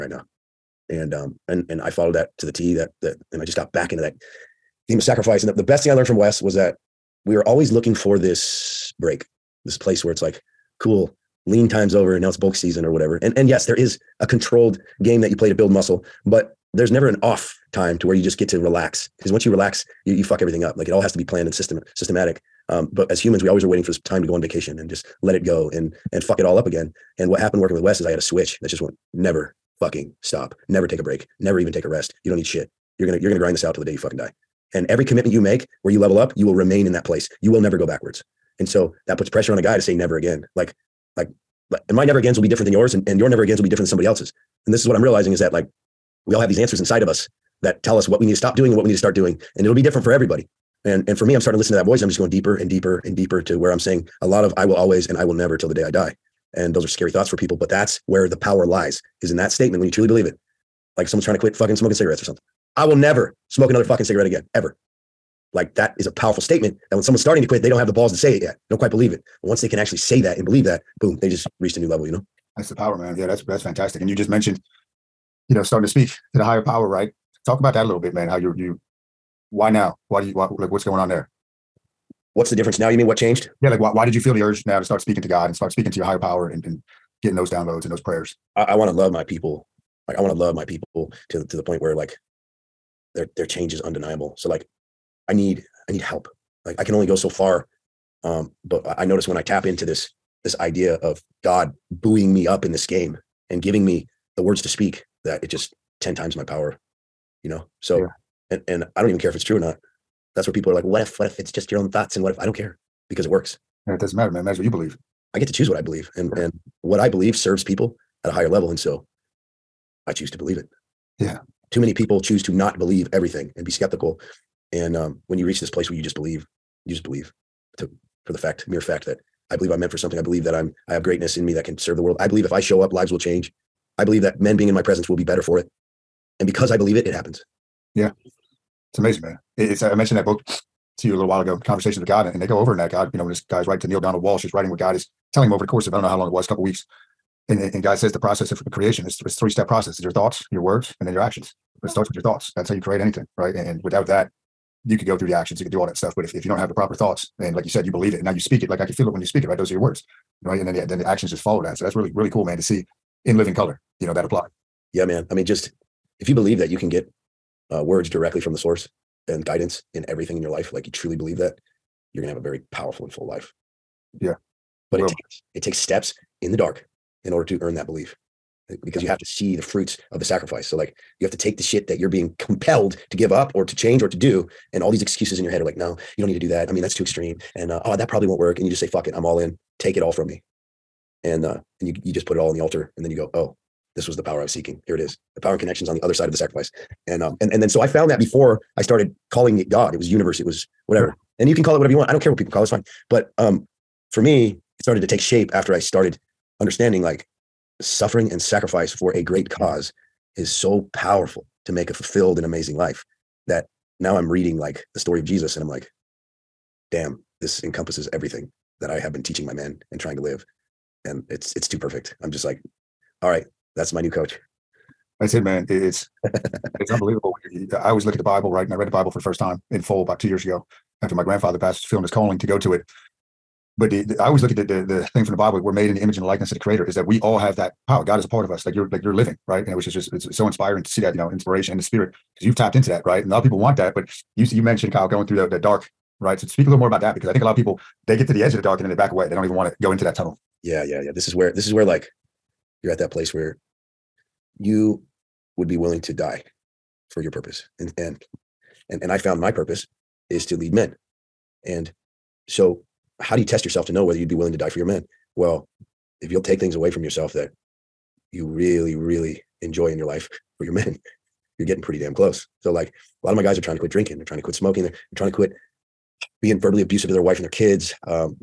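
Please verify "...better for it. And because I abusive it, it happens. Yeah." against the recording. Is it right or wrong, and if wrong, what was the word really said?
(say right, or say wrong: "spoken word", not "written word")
wrong: "believe", not "abusive".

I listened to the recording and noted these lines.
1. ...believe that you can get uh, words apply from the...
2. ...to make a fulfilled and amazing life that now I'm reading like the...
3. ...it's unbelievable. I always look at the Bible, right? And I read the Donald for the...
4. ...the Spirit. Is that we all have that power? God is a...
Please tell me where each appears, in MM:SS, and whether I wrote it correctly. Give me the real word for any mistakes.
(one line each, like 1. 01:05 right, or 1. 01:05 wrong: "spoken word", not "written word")
1. 02:46 wrong: "directly", not "apply"
2. 03:31 right
3. 03:46 wrong: "Bible", not "Donald"
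4. 03:56 wrong: "Creator", not "Spirit".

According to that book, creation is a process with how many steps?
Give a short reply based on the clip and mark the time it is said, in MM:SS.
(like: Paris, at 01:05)
3, at 02:29.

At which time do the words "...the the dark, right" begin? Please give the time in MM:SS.
04:05.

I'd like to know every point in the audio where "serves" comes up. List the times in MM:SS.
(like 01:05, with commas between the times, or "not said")
01:57, 02:11.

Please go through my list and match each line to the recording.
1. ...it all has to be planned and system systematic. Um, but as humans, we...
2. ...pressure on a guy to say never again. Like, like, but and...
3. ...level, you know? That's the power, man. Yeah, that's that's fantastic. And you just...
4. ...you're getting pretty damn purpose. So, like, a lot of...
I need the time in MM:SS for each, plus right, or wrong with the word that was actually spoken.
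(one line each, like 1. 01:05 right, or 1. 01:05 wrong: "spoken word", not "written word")
1. 00:20 right
2. 00:39 right
3. 01:11 right
4. 04:31 wrong: "close", not "purpose".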